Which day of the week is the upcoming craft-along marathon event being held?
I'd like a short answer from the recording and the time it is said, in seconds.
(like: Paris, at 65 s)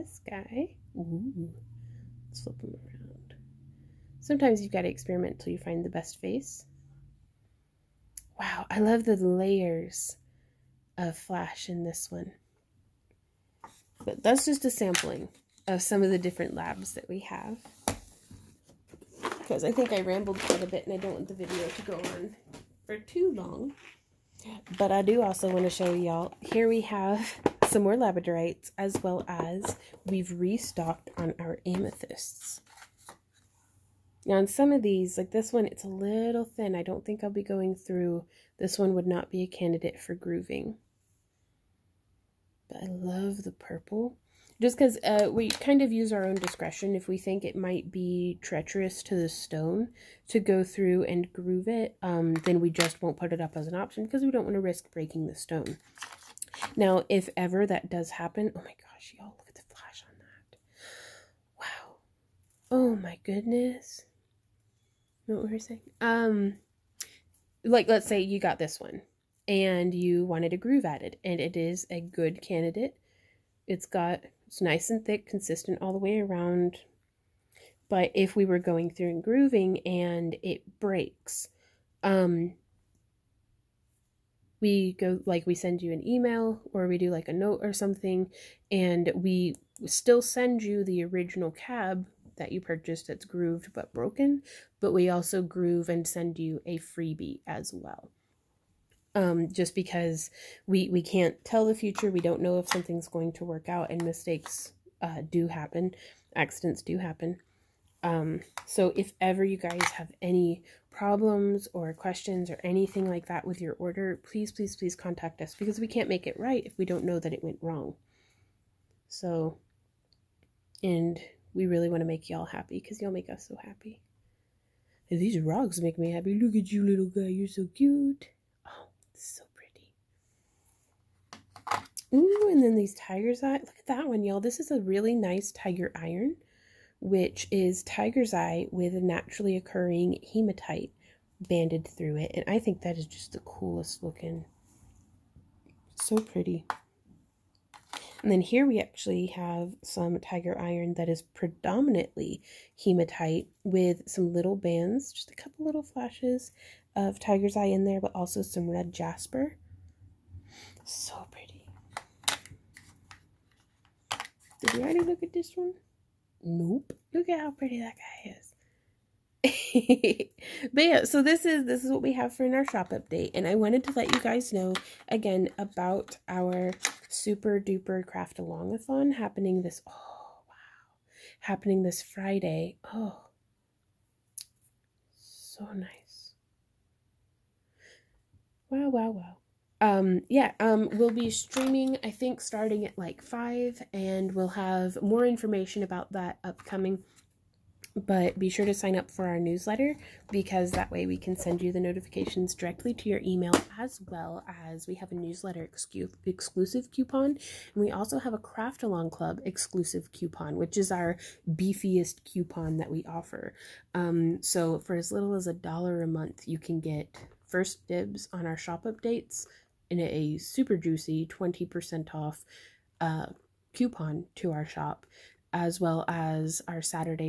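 Friday, at 182 s.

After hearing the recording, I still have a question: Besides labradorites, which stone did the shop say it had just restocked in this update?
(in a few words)
Amethysts.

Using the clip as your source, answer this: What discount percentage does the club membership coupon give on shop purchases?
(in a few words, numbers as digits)
20%.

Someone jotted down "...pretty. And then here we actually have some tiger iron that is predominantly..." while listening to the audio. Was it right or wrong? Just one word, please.
right.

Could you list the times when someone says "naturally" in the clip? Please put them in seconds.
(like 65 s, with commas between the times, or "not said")
139 s.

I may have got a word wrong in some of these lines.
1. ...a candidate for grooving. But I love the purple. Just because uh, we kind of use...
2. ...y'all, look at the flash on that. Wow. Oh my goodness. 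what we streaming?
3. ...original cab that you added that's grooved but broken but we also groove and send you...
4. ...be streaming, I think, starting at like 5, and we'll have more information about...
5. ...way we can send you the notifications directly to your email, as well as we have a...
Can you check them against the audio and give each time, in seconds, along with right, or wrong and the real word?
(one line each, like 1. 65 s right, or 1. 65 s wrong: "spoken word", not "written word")
1. 39 s right
2. 59 s wrong: "saying", not "streaming"
3. 91 s wrong: "purchased", not "added"
4. 191 s right
5. 200 s right.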